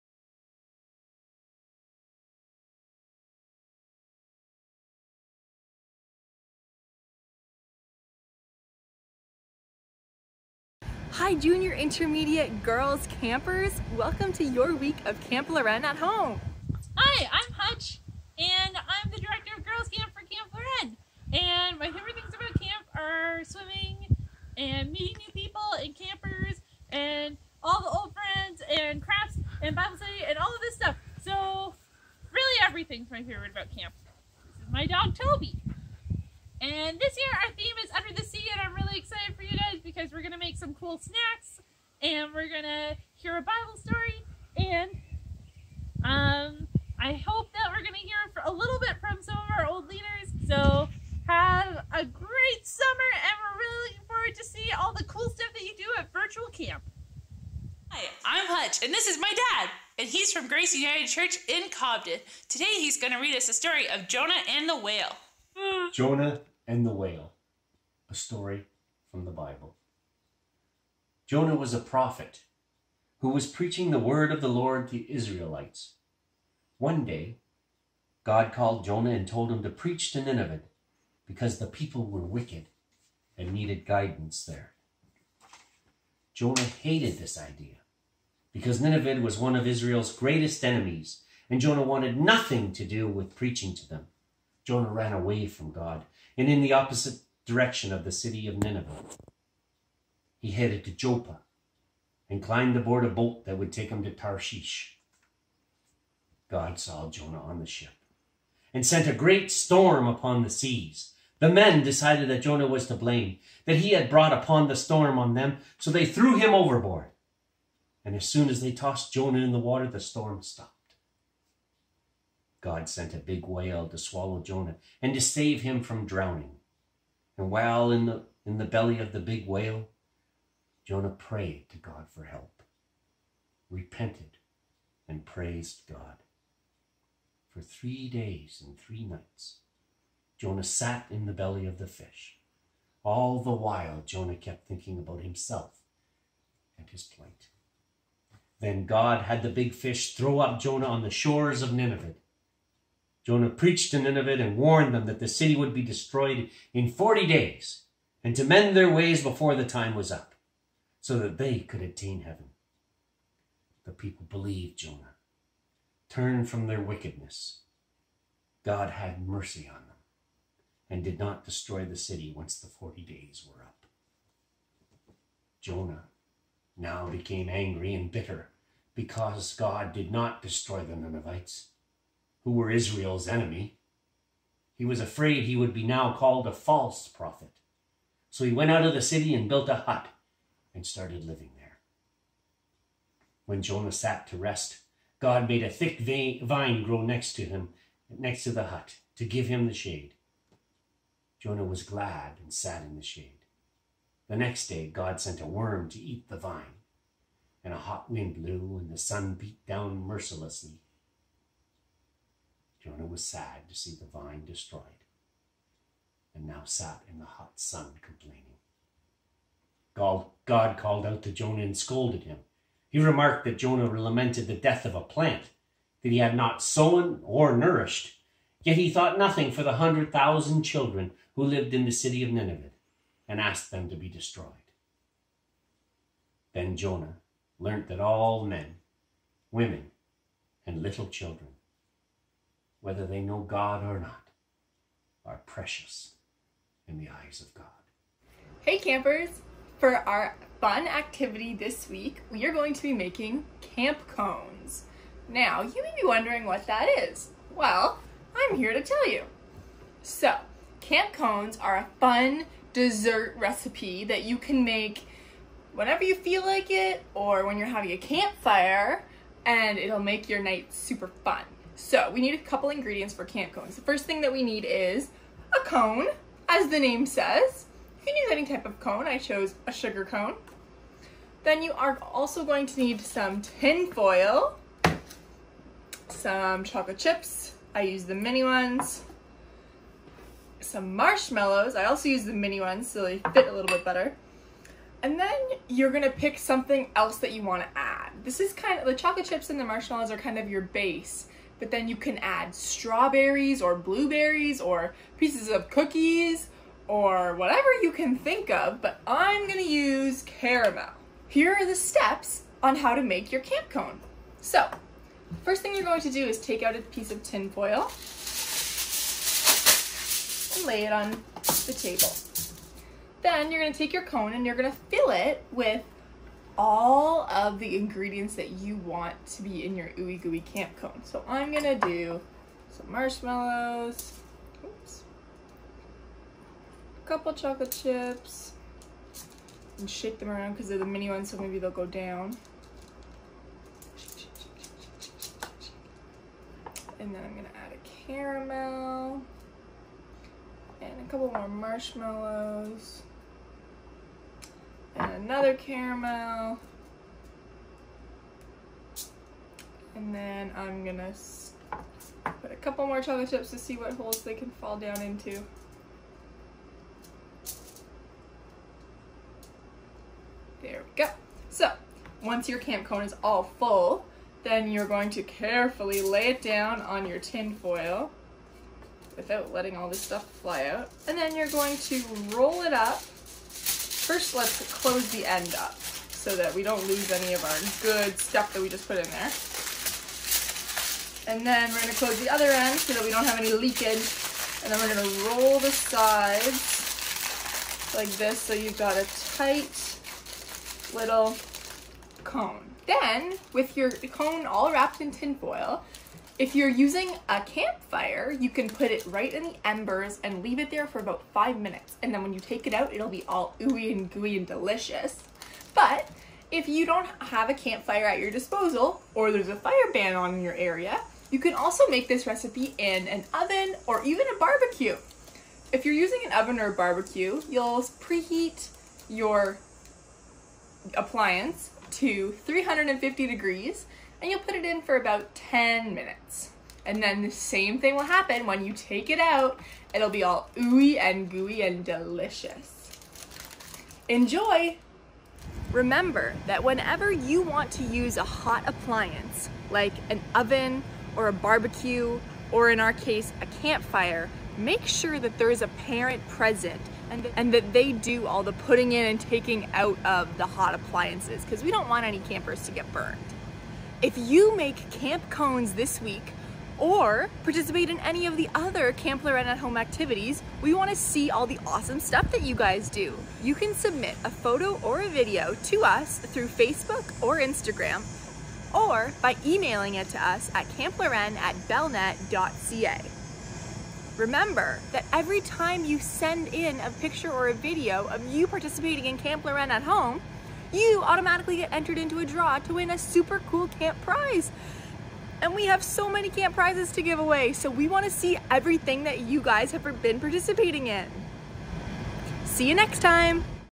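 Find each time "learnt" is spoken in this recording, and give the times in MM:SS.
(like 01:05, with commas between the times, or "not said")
03:57.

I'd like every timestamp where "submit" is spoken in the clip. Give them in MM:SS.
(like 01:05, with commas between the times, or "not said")
07:53.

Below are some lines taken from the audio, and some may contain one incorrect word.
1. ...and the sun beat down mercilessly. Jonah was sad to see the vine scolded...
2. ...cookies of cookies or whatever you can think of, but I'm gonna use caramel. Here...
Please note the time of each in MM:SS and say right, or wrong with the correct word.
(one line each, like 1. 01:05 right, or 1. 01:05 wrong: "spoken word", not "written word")
1. 03:28 wrong: "destroyed", not "scolded"
2. 05:05 wrong: "pieces", not "cookies".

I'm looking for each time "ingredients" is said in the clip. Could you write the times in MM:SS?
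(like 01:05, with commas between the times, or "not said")
04:32, 05:27.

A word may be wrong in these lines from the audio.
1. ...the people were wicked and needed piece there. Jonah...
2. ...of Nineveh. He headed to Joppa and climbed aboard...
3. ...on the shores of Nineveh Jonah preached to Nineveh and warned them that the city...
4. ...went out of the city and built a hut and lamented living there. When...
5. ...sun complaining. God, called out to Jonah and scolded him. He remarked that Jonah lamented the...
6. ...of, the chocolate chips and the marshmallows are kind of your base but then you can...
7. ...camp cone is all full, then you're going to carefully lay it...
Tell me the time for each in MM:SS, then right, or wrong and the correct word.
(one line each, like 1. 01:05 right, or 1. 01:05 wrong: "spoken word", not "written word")
1. 01:21 wrong: "guidance", not "piece"
2. 01:38 right
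3. 02:30 right
4. 03:08 wrong: "started", not "lamented"
5. 03:37 right
6. 04:58 right
7. 06:12 right.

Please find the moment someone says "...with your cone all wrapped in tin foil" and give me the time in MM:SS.
06:43.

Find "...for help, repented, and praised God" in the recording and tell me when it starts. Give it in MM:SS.
02:12.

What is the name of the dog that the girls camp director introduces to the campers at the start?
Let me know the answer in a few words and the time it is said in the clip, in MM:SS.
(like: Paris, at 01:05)
Toby, at 00:35.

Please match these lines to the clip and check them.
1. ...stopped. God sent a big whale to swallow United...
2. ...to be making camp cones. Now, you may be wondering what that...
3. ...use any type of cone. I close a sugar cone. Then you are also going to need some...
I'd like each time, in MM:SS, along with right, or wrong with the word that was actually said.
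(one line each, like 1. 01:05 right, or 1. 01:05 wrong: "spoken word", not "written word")
1. 02:00 wrong: "Jonah", not "United"
2. 04:12 right
3. 04:38 wrong: "chose", not "close".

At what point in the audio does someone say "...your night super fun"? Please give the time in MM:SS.
04:30.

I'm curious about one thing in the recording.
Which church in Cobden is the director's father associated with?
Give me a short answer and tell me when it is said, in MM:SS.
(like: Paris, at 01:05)
Grace United Church, at 01:00.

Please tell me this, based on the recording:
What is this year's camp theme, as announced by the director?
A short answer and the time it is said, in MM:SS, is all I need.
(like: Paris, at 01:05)
Under the Sea, at 00:37.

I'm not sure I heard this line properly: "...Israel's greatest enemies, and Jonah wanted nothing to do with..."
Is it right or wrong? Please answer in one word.
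right.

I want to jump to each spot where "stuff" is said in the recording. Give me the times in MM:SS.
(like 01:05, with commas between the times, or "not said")
00:30, 00:55, 06:19, 06:28, 07:51.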